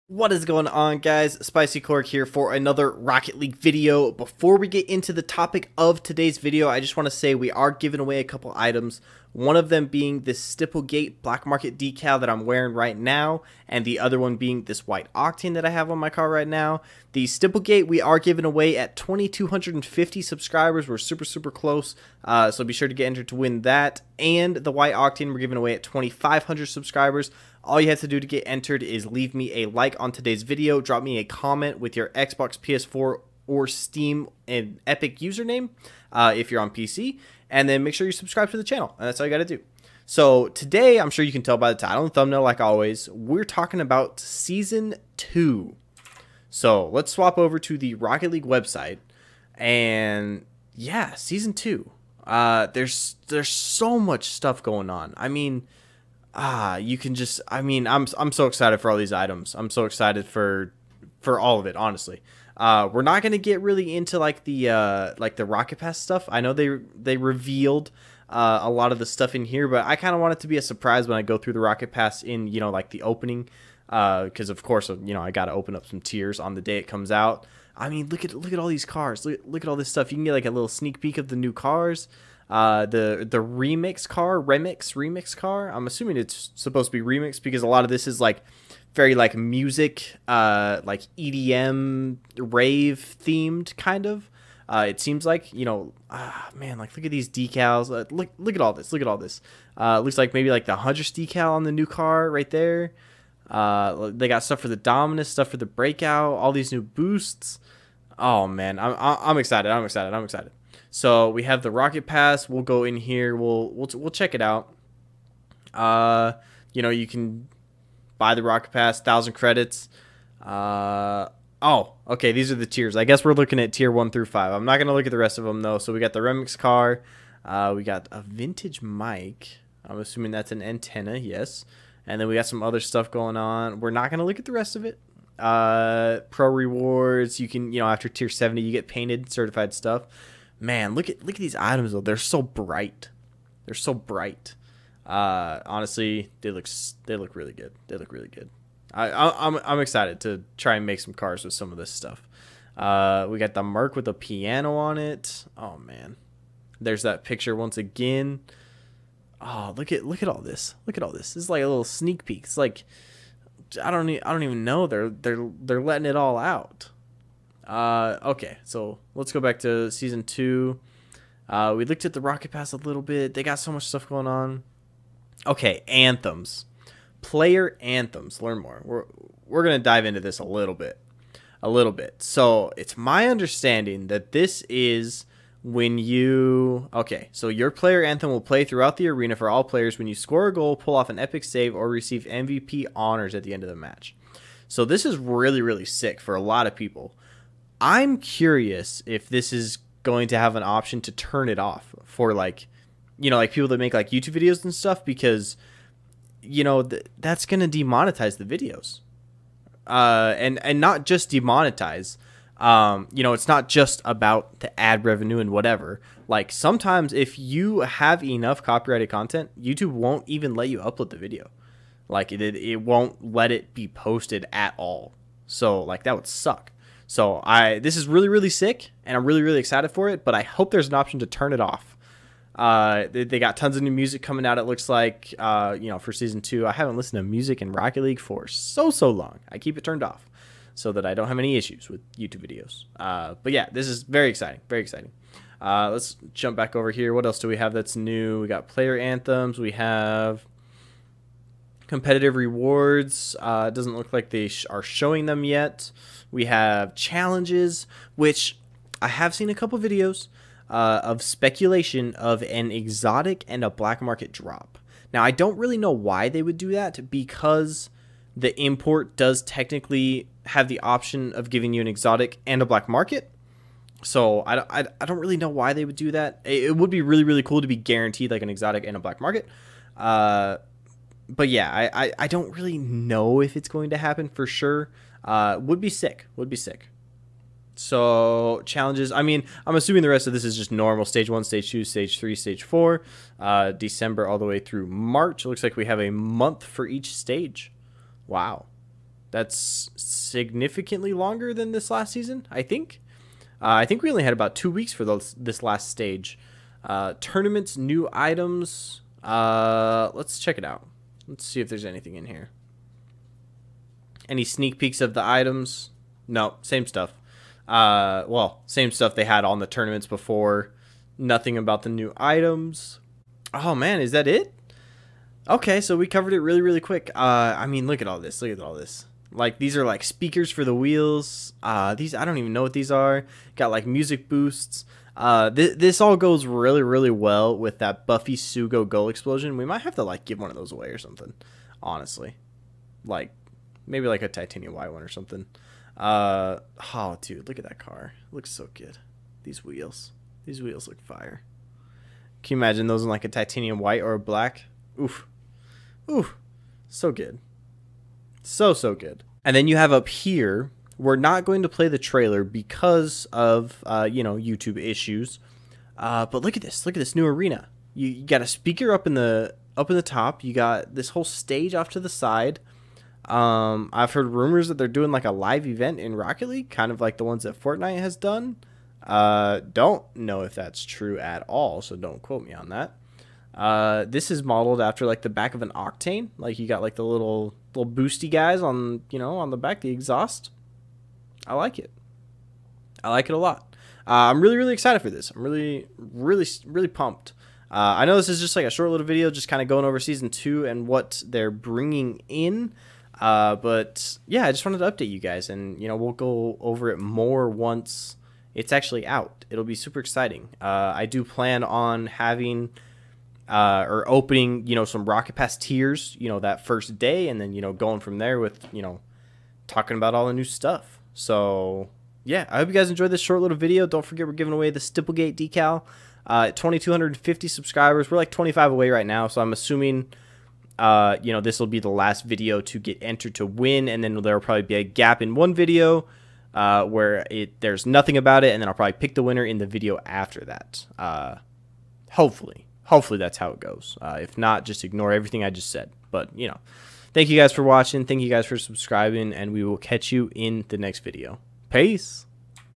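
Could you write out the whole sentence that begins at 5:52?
Can you imagine those in like a titanium white or a black?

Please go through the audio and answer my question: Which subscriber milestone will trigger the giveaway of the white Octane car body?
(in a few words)
2,500.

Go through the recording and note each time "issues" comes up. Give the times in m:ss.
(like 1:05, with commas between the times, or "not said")
4:01, 6:04.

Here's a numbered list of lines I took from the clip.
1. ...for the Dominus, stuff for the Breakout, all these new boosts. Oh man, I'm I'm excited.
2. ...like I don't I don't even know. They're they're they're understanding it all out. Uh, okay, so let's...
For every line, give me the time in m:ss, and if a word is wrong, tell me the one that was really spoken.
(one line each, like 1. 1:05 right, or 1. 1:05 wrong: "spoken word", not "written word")
1. 1:44 right
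2. 2:42 wrong: "letting", not "understanding".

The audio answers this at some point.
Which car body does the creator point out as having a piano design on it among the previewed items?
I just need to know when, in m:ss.
2:33.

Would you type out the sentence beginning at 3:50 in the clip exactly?
But I hope there's an option to turn it off.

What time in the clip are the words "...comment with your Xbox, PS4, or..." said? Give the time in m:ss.
0:31.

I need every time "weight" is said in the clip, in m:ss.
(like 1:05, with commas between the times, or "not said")
not said.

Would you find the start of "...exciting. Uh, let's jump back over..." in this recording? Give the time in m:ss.
4:04.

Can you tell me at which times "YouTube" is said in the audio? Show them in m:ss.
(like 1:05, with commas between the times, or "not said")
3:24, 3:39, 4:02, 6:04.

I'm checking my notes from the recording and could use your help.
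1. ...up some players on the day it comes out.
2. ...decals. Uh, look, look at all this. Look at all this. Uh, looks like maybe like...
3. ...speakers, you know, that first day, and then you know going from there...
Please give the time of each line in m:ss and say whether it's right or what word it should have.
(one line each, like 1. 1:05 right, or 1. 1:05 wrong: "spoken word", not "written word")
1. 1:15 wrong: "tiers", not "players"
2. 1:37 right
3. 6:55 wrong: "tiers", not "speakers".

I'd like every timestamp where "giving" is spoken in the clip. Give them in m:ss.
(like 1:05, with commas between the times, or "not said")
0:07, 0:18, 0:25, 4:31, 7:04.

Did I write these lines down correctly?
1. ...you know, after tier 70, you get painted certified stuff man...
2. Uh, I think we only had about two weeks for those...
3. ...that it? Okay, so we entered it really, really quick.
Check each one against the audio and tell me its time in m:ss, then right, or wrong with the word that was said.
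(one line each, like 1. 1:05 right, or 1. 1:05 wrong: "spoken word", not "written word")
1. 2:17 right
2. 5:03 right
3. 5:24 wrong: "covered", not "entered".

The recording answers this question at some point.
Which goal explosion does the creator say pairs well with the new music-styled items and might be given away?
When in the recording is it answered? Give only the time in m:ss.
5:38.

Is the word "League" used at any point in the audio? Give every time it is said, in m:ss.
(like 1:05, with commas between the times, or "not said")
0:03, 0:48, 3:58, 6:16.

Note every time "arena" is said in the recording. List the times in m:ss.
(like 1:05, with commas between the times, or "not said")
3:09, 6:07.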